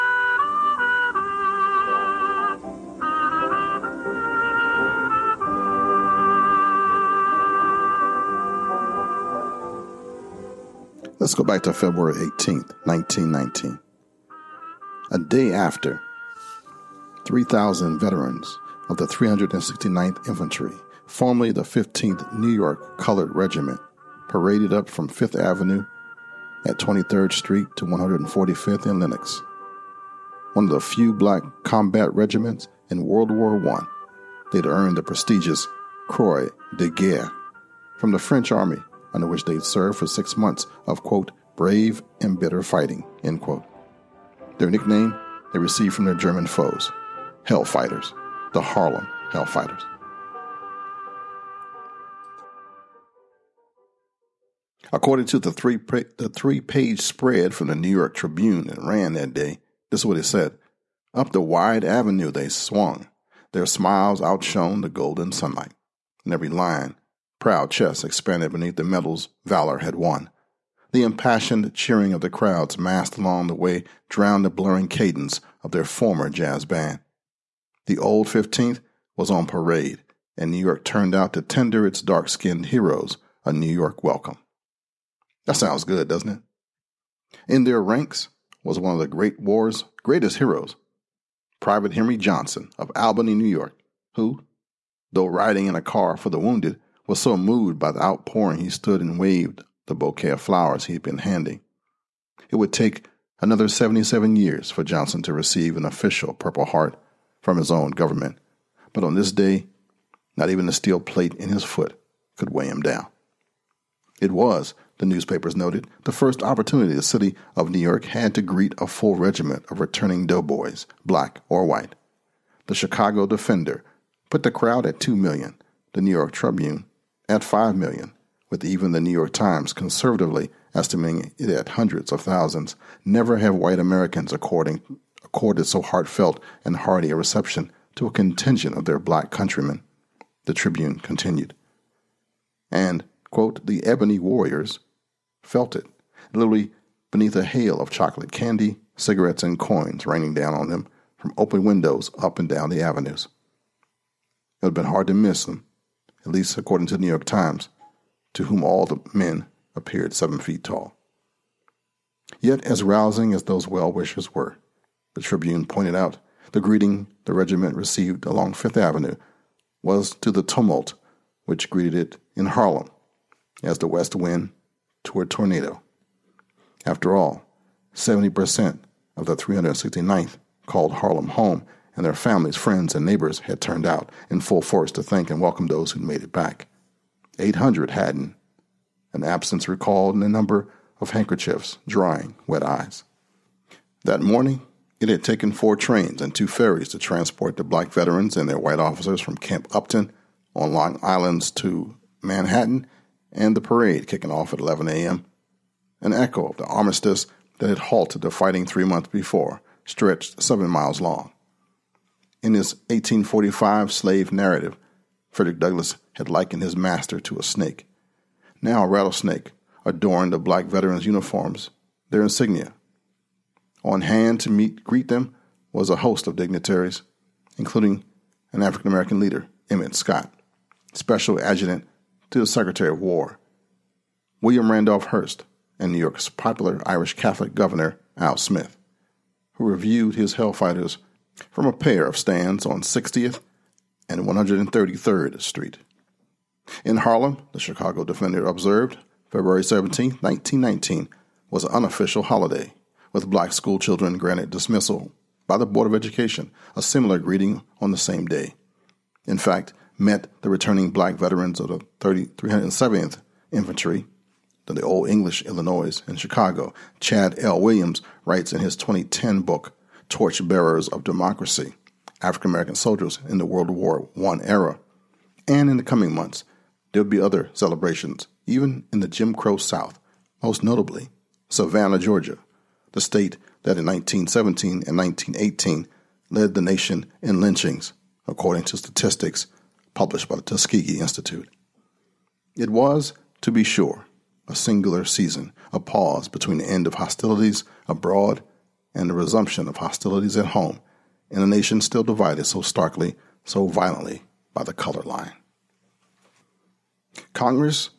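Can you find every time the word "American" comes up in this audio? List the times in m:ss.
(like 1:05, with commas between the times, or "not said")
2:13, 3:48, 4:32.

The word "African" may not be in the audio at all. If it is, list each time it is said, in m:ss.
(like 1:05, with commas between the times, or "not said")
3:48, 4:32.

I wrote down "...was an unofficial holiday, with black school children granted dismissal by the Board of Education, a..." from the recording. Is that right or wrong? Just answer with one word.
right.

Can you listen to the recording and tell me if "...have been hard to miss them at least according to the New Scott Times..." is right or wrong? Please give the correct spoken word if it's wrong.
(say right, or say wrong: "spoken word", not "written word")
wrong: "York", not "Scott".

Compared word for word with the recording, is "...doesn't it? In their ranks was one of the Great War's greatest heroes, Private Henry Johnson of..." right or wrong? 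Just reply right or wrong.
right.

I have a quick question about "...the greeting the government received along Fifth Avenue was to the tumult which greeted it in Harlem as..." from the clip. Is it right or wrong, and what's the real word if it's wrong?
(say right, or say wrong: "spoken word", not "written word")
wrong: "regiment", not "government".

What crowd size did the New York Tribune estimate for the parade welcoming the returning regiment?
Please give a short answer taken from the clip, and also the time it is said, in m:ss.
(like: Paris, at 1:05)
5 million, at 2:07.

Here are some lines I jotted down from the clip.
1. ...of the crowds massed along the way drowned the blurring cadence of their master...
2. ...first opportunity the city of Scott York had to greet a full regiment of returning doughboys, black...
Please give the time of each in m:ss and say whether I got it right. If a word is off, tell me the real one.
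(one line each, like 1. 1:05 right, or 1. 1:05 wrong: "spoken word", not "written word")
1. 1:12 wrong: "former", not "master"
2. 1:56 wrong: "New", not "Scott".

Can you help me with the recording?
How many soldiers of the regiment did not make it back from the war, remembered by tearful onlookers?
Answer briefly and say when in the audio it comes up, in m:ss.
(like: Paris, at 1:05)
800, at 3:07.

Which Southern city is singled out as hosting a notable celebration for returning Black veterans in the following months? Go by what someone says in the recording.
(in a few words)
Savannah, Georgia.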